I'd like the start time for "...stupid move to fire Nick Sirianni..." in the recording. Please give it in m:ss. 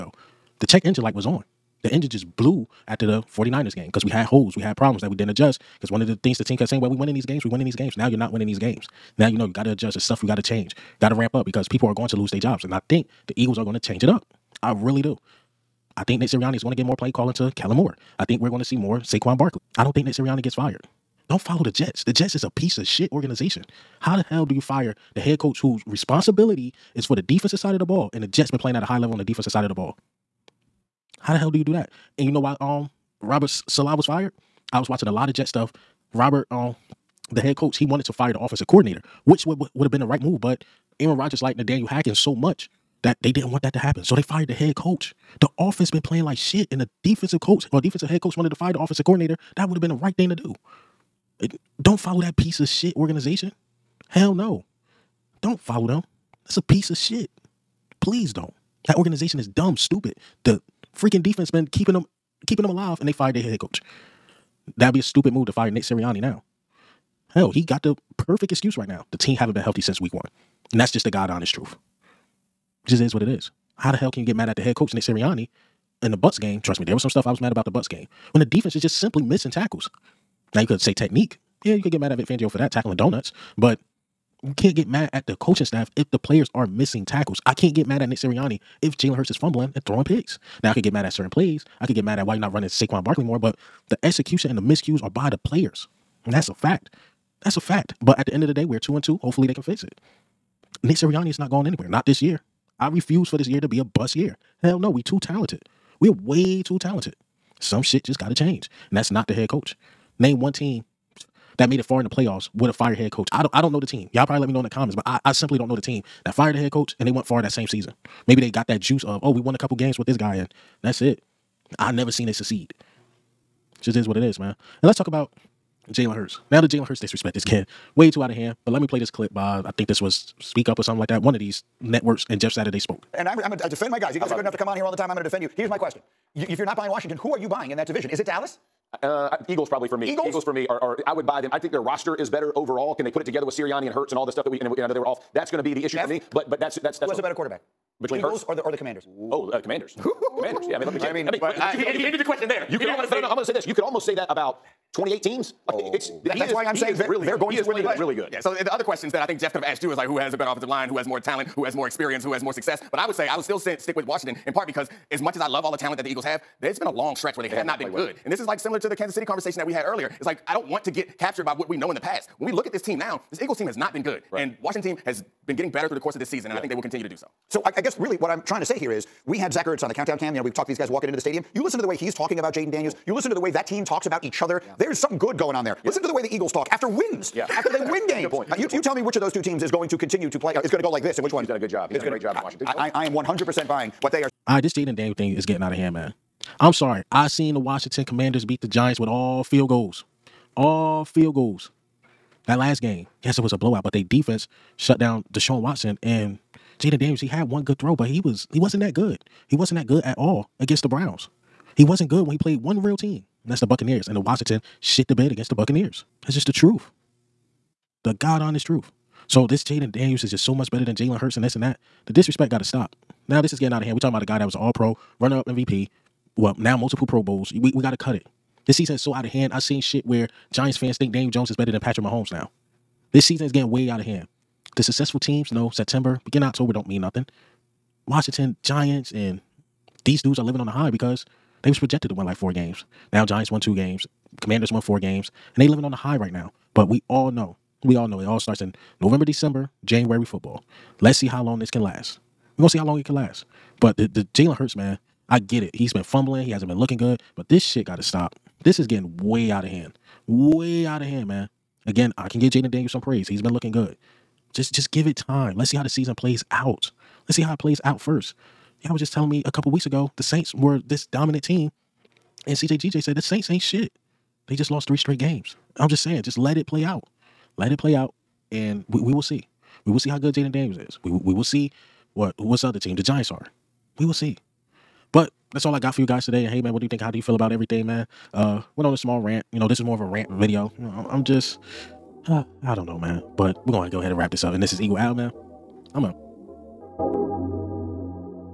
1:05.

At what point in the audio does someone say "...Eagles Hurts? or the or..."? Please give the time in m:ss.
2:28.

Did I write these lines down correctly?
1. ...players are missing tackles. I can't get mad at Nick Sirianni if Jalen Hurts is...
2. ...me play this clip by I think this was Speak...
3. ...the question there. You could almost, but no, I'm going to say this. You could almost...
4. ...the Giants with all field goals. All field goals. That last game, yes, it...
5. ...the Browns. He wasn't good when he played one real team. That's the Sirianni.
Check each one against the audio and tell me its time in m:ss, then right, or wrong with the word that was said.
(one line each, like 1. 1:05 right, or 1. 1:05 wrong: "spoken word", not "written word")
1. 1:26 right
2. 2:08 right
3. 2:32 right
4. 3:18 right
5. 3:30 wrong: "Buccaneers", not "Sirianni".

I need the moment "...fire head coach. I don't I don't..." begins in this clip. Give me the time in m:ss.
1:52.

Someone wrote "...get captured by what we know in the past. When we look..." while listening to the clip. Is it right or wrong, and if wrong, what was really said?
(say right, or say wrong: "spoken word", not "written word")
right.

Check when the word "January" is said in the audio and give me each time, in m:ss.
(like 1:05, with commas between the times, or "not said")
4:09.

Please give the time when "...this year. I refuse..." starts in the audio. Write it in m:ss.
1:42.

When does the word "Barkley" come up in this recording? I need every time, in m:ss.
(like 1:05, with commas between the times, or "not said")
0:19, 1:33.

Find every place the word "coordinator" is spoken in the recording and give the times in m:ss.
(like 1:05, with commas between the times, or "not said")
0:38, 0:49.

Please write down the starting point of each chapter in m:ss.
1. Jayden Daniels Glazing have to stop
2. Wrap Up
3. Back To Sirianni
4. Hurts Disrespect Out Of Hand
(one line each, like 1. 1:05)
1. 3:15
2. 4:46
3. 1:08
4. 2:07.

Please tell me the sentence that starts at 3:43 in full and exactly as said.
Now this is getting out of hand.